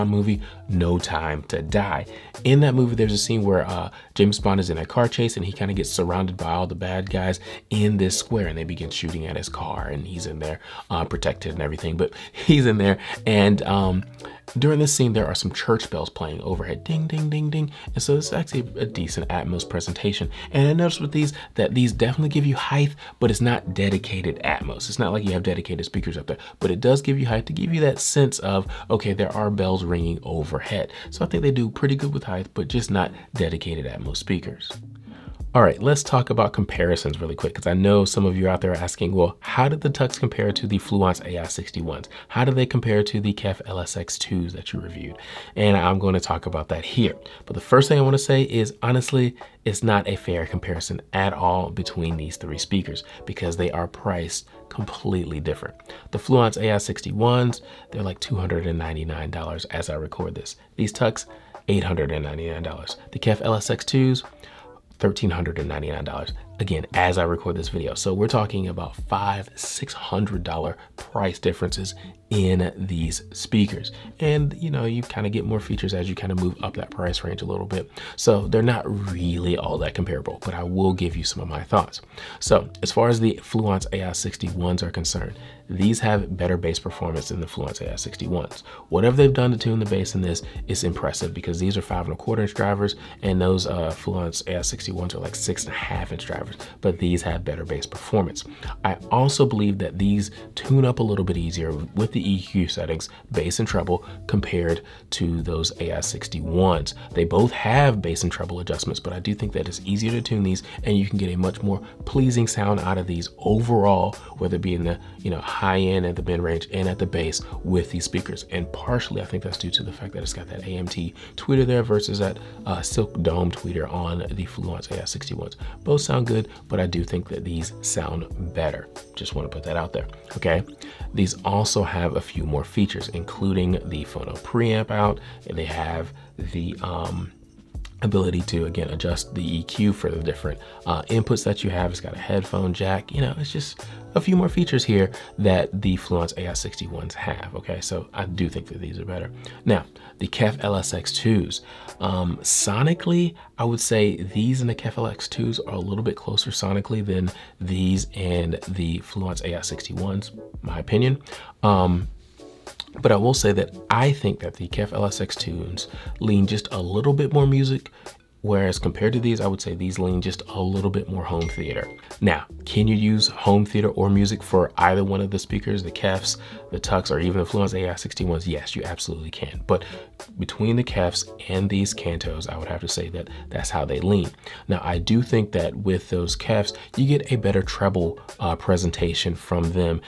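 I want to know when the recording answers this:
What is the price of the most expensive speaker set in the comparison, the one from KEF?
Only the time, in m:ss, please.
1:04.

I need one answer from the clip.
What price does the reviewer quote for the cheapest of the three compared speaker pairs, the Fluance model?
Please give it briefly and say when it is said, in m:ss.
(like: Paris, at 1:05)
$299, at 0:58.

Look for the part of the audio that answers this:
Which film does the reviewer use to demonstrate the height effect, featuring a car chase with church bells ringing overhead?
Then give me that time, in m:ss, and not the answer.
0:00.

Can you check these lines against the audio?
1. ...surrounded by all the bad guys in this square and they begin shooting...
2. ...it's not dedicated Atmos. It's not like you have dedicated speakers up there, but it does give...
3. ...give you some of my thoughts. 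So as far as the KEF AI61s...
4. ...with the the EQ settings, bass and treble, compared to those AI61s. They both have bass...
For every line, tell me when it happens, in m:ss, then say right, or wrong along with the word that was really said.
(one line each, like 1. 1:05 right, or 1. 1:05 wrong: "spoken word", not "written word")
1. 0:05 right
2. 0:23 right
3. 1:20 wrong: "Fluance", not "KEF"
4. 1:41 right.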